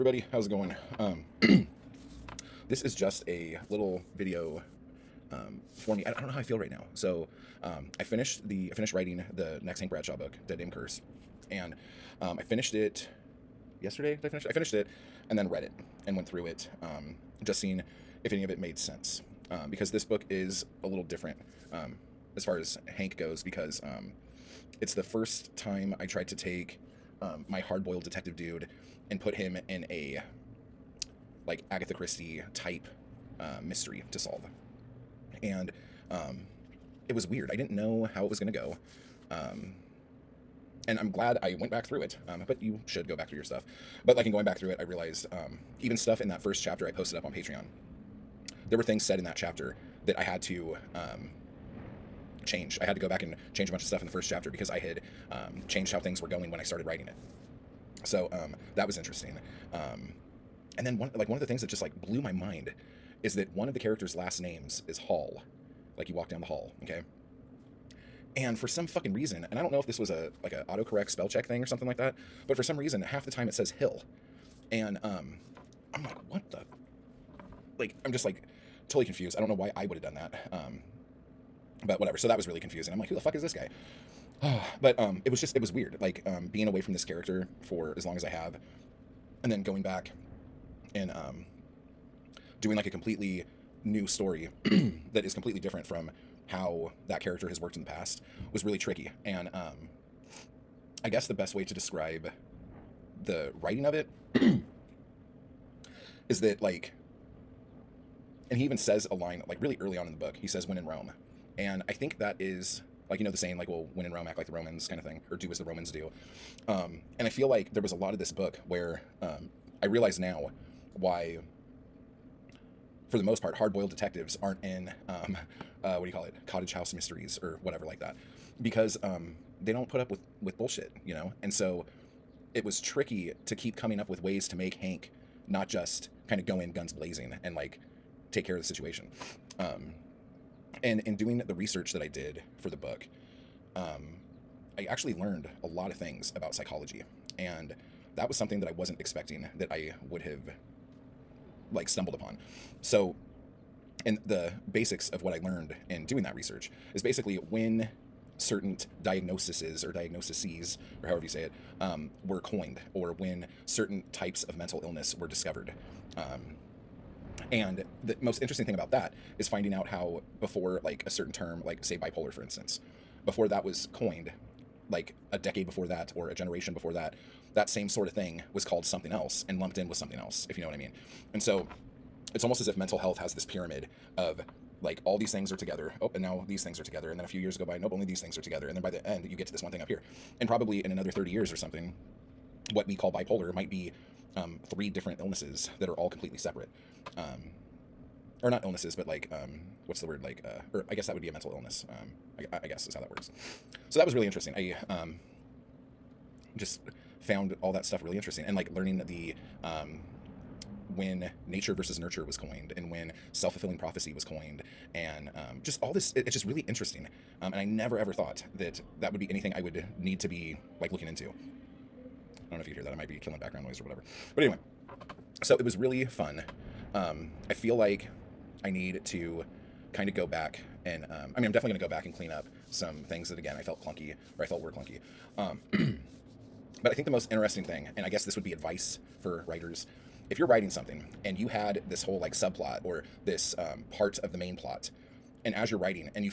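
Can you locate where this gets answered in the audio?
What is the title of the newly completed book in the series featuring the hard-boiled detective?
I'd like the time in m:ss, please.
0:10.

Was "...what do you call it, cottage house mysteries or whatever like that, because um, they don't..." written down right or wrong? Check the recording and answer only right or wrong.
right.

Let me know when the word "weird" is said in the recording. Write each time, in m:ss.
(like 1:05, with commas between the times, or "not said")
0:37, 1:25.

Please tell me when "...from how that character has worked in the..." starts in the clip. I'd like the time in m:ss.
1:35.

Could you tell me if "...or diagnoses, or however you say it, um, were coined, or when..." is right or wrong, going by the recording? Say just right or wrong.
right.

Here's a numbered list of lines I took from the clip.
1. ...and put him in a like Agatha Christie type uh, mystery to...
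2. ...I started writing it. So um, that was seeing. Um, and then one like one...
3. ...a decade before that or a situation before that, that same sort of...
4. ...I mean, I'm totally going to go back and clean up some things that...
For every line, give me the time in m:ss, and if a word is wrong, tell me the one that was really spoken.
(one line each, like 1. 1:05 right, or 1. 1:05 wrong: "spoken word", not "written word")
1. 0:29 right
2. 0:56 wrong: "interesting", not "seeing"
3. 2:55 wrong: "generation", not "situation"
4. 3:51 wrong: "definitely", not "totally".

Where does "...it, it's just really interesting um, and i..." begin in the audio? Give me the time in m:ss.
3:36.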